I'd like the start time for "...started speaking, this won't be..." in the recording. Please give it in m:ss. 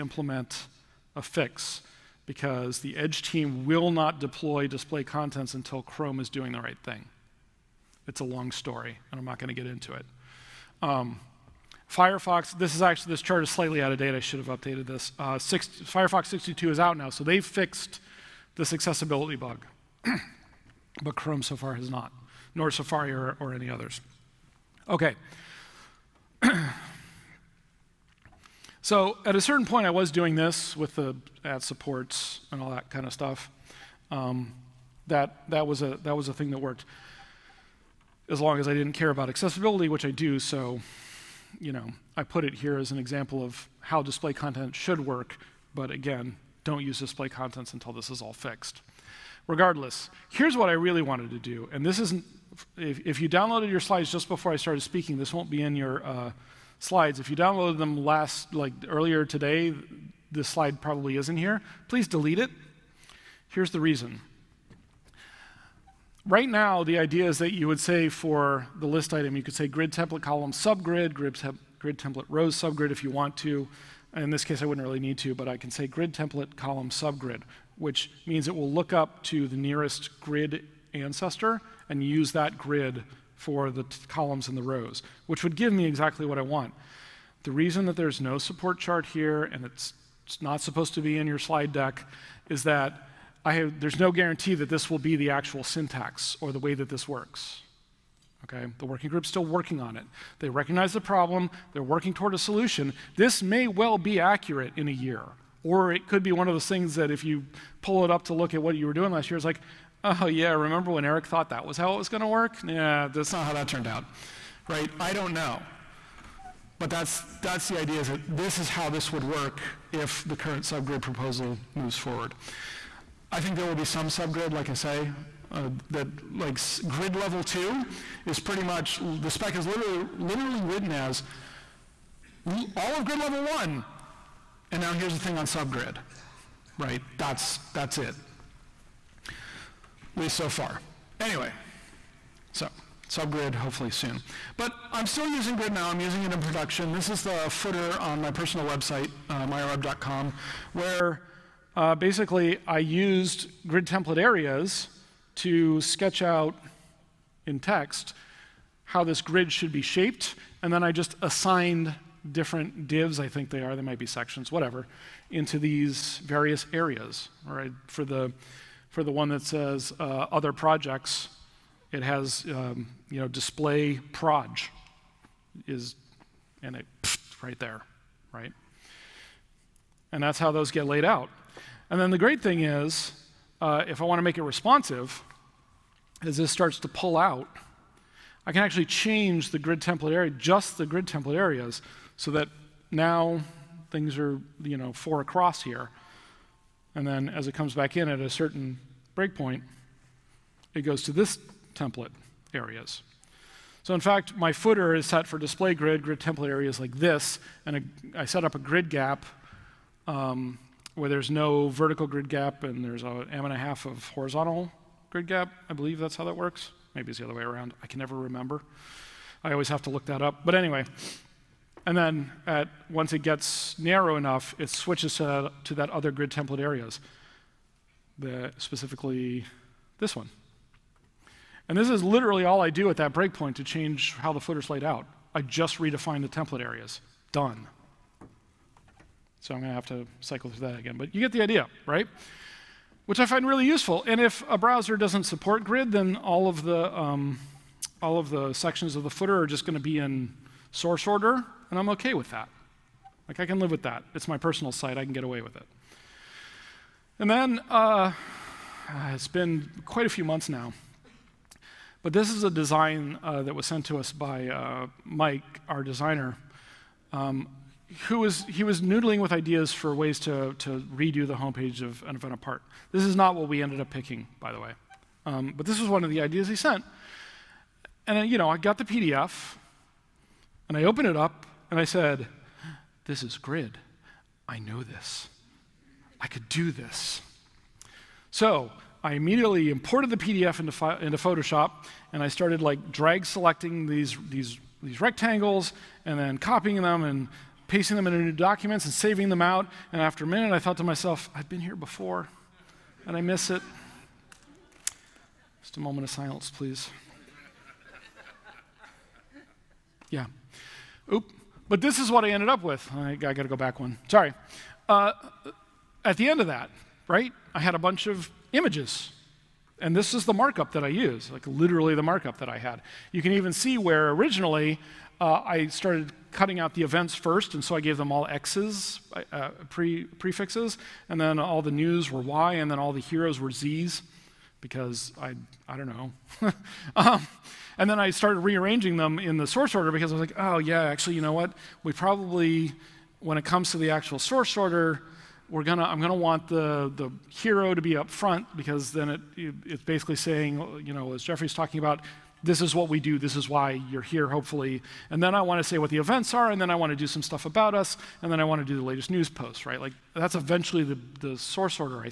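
0:54.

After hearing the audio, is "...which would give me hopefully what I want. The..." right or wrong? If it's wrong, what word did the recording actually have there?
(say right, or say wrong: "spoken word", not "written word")
wrong: "exactly", not "hopefully".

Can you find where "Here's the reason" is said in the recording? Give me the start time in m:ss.
1:03.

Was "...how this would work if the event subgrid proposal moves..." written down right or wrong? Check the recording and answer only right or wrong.
wrong.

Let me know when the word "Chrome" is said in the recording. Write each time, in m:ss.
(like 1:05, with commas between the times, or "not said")
0:05, 0:21.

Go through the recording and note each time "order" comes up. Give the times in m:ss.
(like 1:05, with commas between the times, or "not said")
4:11, 5:39, 5:44.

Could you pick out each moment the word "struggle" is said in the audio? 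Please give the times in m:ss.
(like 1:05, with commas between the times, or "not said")
not said.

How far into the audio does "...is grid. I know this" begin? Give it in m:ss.
4:43.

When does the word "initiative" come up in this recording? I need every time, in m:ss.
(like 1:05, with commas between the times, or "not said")
not said.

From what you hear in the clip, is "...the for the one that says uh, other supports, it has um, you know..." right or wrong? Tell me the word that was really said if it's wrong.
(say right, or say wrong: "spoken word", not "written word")
wrong: "projects", not "supports".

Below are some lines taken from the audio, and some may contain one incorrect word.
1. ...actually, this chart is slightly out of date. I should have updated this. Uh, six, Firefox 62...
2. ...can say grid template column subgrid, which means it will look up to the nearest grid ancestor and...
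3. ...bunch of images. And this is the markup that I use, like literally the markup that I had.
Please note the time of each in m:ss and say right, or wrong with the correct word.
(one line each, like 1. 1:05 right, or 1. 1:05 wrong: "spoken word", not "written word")
1. 0:12 right
2. 1:15 right
3. 5:17 right.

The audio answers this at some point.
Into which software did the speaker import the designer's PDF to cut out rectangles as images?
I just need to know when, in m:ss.
4:51.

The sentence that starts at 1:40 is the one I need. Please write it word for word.
They recognize the problem, they're working toward a solution.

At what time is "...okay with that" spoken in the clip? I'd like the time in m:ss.
4:11.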